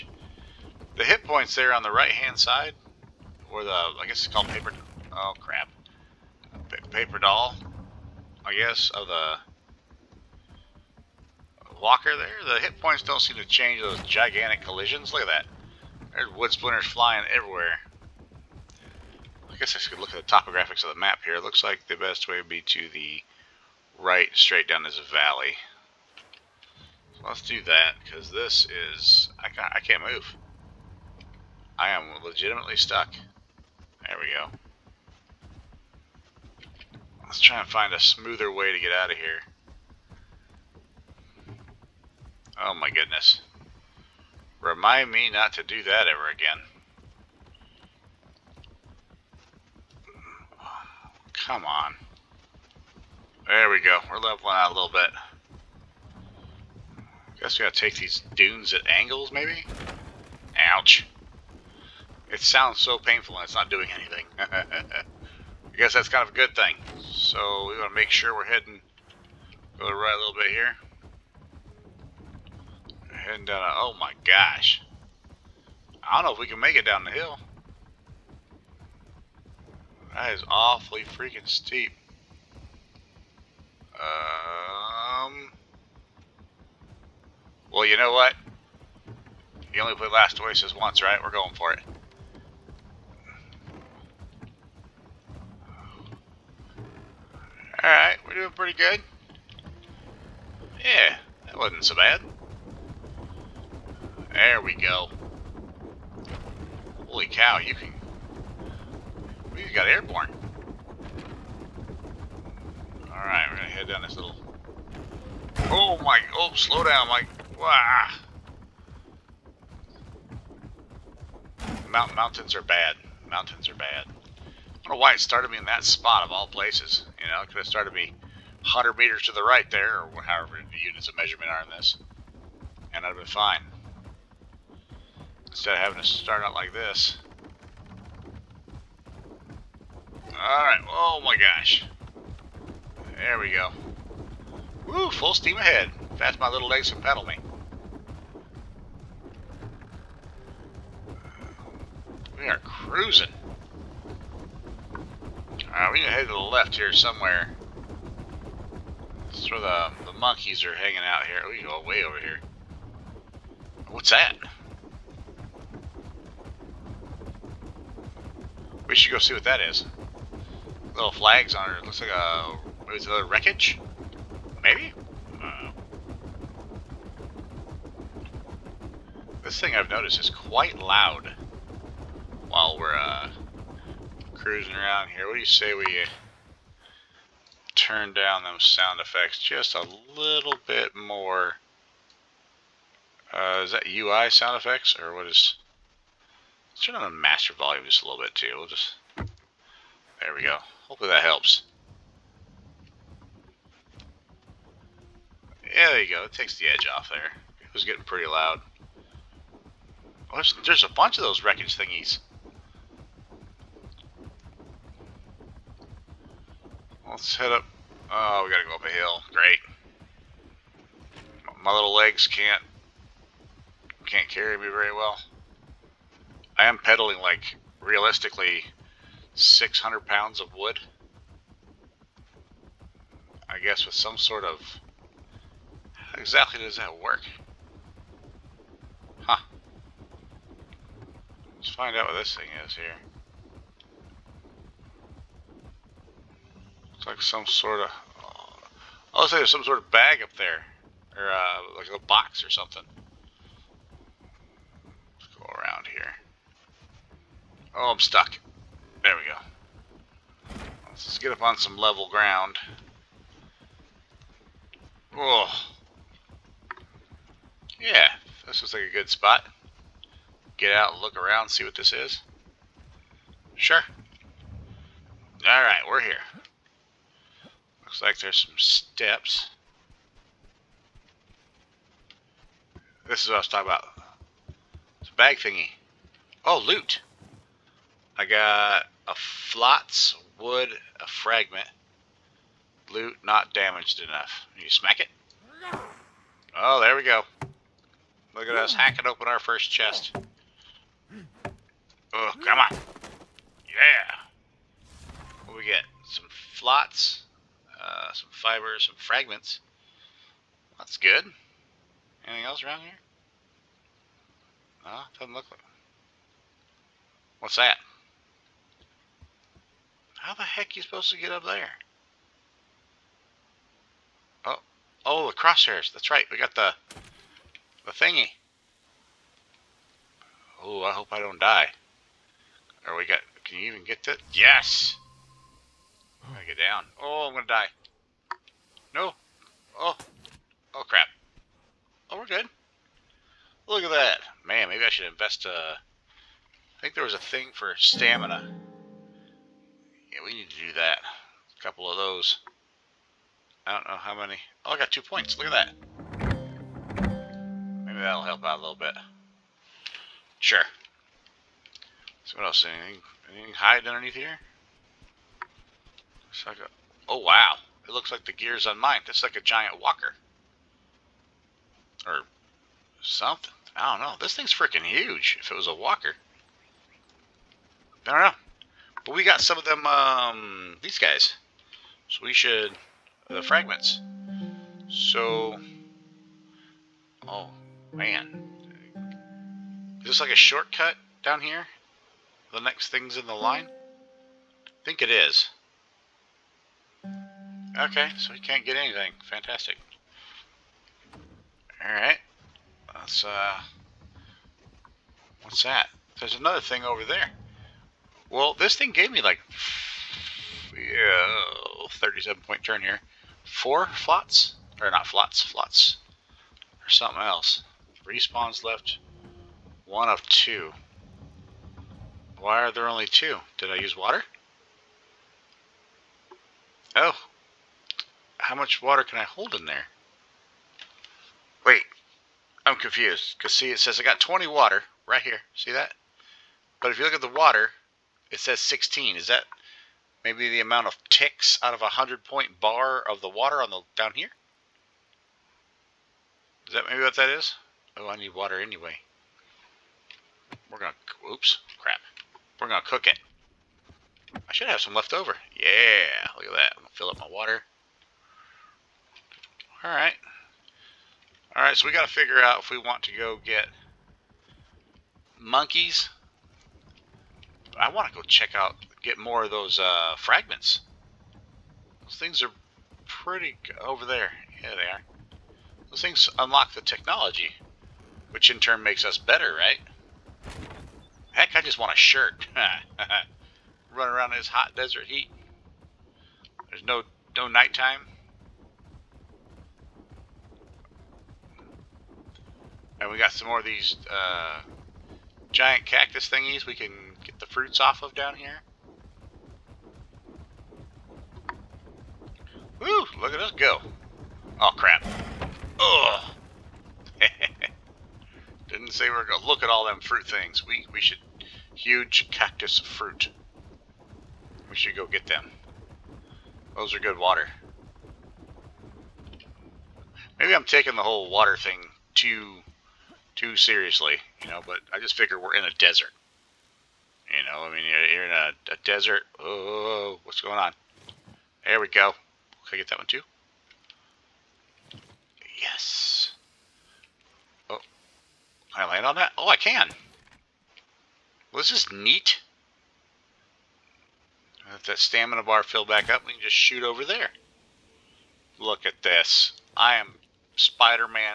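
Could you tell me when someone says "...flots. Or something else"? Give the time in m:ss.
6:55.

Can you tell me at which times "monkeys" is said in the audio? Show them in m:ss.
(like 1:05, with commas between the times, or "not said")
2:40, 7:45.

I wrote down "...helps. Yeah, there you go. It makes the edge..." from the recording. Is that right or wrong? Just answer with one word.
wrong.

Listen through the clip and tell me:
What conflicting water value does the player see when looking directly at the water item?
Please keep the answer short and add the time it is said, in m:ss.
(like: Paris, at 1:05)
16, at 7:18.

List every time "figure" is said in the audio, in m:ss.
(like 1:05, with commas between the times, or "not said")
7:42, 8:45.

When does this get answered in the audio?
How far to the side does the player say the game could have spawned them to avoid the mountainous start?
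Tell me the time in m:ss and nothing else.
2:08.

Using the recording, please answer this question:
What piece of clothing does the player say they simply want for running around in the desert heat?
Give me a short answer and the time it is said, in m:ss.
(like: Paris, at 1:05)
a shirt, at 8:01.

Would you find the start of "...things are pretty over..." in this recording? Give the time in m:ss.
7:52.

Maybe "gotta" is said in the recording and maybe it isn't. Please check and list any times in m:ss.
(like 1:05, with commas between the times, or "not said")
0:57, 3:38.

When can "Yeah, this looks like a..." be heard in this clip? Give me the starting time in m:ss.
4:27.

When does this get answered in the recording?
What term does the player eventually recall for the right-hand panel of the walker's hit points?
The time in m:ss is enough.
0:06.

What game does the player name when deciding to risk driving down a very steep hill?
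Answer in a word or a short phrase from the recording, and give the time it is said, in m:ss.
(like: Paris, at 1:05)
Last Oasis, at 1:30.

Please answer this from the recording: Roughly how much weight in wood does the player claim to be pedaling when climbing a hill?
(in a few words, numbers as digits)
600 pounds.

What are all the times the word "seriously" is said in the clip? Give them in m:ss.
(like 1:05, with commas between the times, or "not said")
8:43.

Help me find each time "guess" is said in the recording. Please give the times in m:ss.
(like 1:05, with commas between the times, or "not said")
0:04, 0:08, 0:19, 0:57, 1:05, 3:53.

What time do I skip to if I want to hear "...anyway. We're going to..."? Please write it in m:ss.
7:28.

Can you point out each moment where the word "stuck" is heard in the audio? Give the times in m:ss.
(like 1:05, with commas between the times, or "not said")
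0:32, 4:17.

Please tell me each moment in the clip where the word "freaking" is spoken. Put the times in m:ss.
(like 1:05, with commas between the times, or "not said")
1:21, 6:14.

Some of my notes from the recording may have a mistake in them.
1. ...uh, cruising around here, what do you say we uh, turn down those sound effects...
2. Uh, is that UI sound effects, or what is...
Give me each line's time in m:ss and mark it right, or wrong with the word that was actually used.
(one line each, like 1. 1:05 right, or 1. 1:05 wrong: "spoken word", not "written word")
1. 3:02 right
2. 3:13 right.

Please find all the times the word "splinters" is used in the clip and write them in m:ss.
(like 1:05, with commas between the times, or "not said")
0:16.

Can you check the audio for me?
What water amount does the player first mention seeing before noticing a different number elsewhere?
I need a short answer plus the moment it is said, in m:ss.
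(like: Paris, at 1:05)
20, at 7:14.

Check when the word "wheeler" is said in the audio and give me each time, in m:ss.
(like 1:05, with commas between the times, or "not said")
not said.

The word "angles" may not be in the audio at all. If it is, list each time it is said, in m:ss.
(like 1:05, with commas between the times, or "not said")
0:58.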